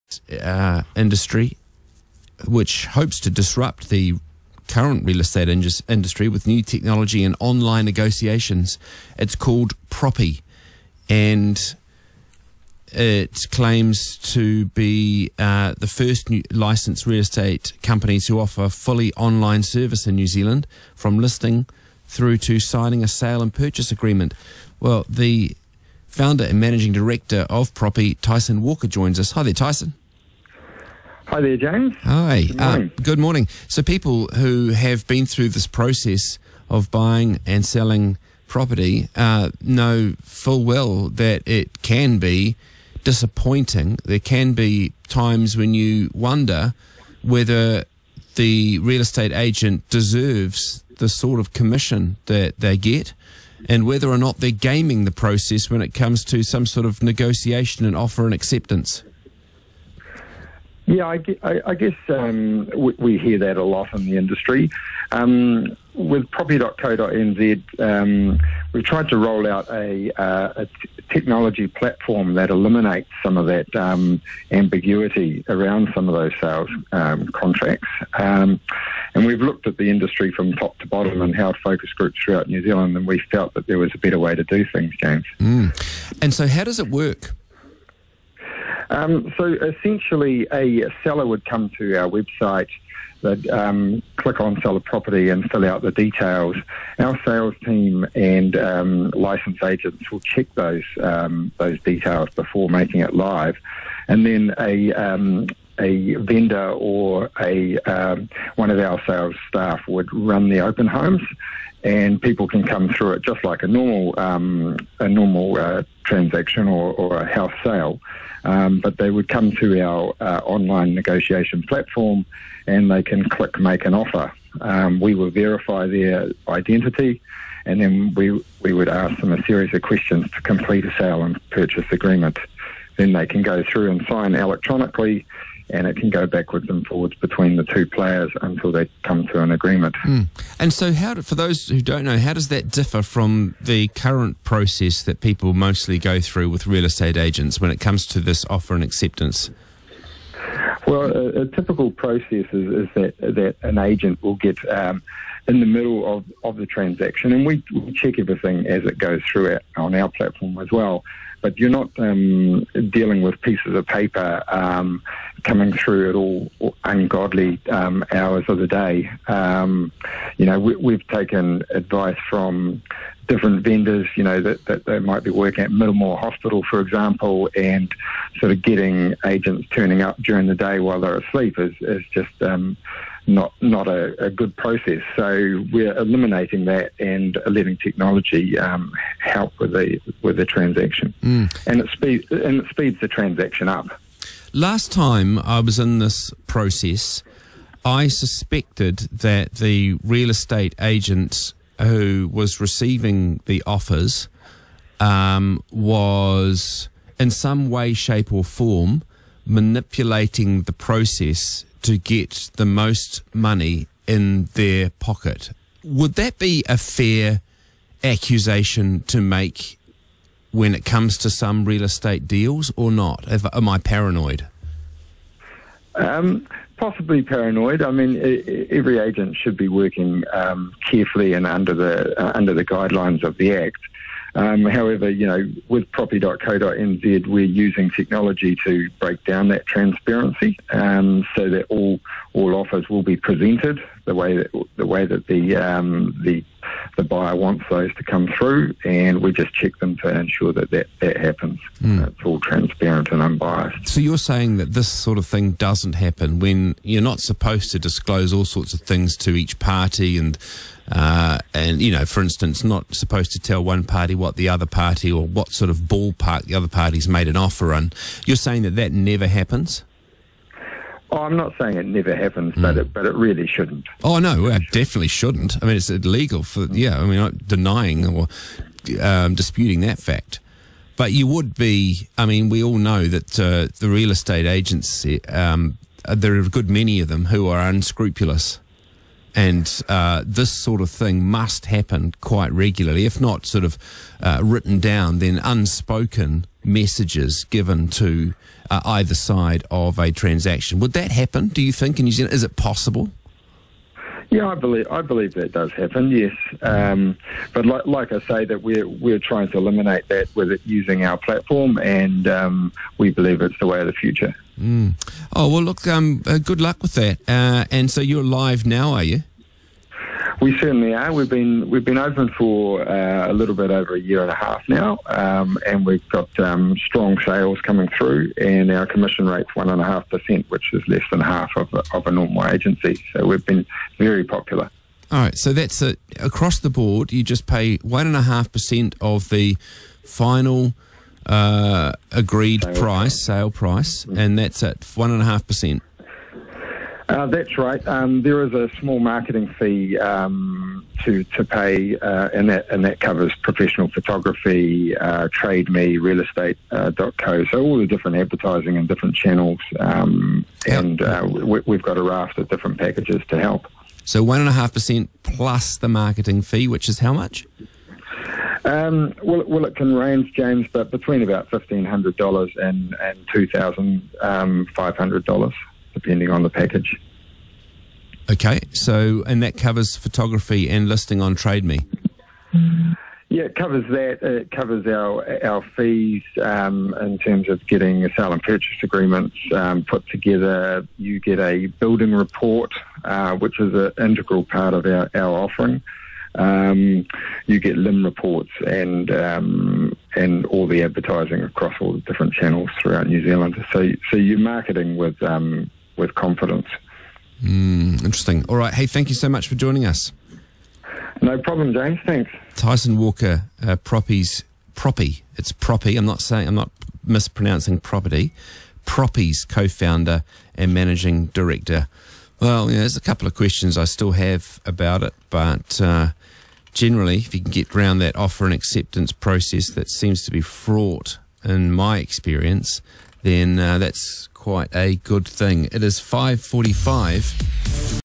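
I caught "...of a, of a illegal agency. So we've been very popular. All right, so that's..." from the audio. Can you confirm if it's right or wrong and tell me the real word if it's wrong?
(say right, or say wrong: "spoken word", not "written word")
wrong: "normal", not "illegal".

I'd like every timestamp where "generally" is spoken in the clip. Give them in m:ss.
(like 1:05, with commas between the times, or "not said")
7:06.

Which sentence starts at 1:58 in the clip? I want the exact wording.
Um, but they would come to our uh, online negotiation platform, and they can click make an offer.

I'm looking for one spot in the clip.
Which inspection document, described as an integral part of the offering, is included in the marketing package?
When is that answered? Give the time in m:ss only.
6:31.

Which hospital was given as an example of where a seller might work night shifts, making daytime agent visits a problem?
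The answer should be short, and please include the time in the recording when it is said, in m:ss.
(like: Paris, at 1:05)
Middlemore Hospital, at 2:55.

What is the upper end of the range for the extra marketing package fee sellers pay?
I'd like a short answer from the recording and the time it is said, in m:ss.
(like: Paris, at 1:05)
$2,500, at 6:13.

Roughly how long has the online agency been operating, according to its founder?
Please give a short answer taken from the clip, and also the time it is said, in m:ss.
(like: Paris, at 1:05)
a year and a half, at 5:23.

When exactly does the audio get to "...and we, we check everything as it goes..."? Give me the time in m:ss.
2:37.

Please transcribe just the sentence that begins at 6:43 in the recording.
So so you're marketing with um, with confidence.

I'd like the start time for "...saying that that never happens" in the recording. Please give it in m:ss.
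4:28.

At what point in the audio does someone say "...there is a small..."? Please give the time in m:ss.
5:48.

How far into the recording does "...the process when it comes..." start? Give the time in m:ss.
0:55.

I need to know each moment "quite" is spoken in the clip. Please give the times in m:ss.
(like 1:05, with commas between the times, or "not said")
4:52, 7:14.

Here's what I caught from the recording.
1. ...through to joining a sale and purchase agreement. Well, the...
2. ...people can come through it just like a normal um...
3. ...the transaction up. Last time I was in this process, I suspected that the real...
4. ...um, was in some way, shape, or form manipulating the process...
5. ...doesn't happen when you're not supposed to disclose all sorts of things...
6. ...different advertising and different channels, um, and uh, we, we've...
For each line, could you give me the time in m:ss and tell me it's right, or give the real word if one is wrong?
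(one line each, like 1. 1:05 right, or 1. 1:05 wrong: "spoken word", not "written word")
1. 0:22 wrong: "signing", not "joining"
2. 1:52 right
3. 3:13 right
4. 3:24 right
5. 4:15 right
6. 5:57 right.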